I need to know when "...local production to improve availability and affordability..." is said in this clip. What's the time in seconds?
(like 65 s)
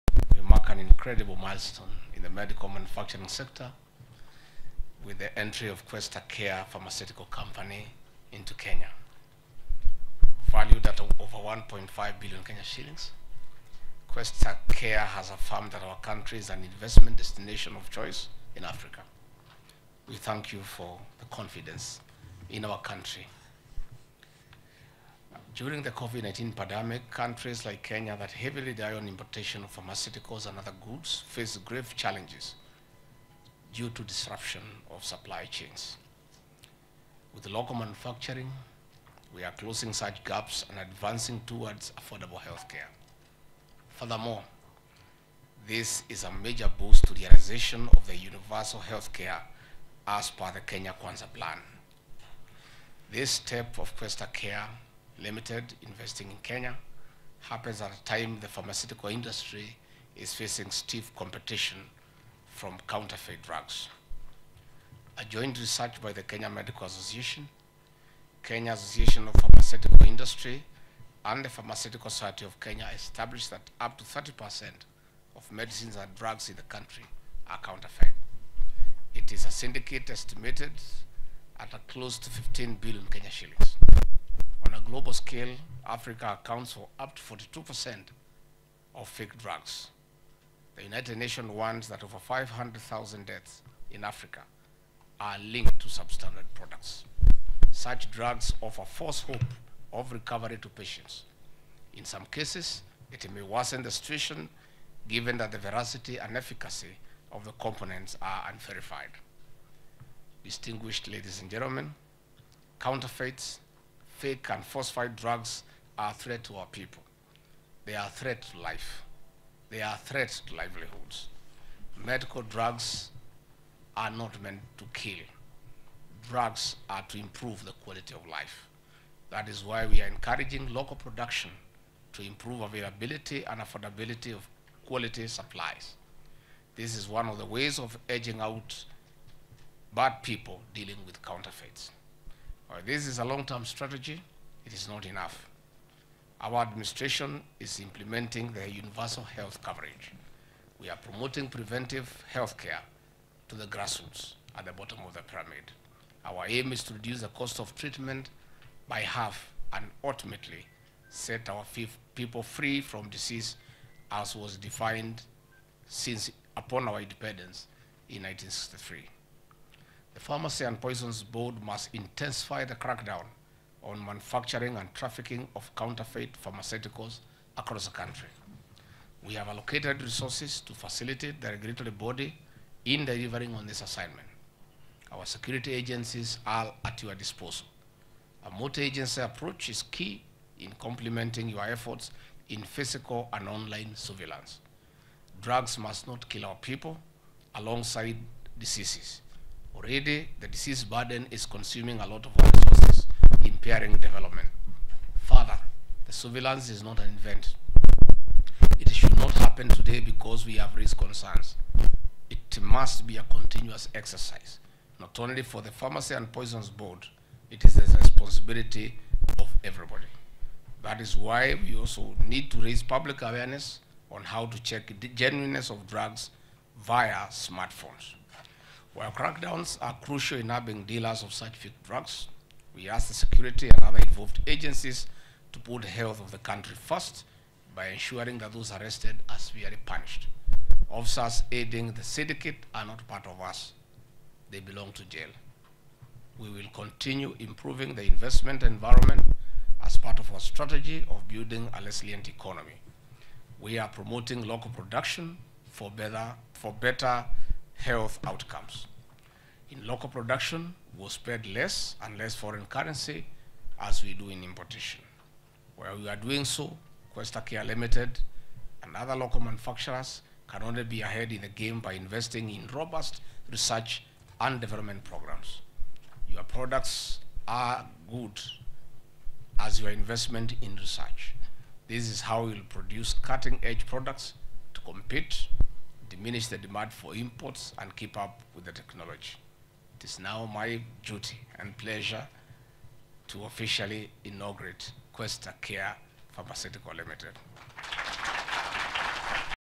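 130 s.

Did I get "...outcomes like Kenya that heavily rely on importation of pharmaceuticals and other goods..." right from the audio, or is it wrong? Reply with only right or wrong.
wrong.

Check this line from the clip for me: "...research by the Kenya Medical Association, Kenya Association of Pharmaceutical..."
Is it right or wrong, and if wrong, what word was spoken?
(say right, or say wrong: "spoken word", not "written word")
right.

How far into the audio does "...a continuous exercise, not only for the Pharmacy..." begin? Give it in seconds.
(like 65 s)
213 s.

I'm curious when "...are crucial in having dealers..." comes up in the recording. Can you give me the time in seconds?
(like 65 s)
229 s.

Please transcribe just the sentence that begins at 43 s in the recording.
Furthermore, this is a major boost to the realization of the universal healthcare as per the Kenya Kwanza Plan.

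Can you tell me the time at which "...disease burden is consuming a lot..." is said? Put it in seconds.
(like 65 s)
200 s.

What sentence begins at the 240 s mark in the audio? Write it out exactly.
Officers aiding the syndicate are not part of us.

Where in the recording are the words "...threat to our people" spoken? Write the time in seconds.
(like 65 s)
116 s.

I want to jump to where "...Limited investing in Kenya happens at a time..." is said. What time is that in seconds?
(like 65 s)
55 s.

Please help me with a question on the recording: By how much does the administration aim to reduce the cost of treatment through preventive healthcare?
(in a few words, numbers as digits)
by half.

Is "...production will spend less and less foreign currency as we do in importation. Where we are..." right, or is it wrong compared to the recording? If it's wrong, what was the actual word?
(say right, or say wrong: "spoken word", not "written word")
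right.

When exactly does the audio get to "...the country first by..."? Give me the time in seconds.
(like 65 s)
236 s.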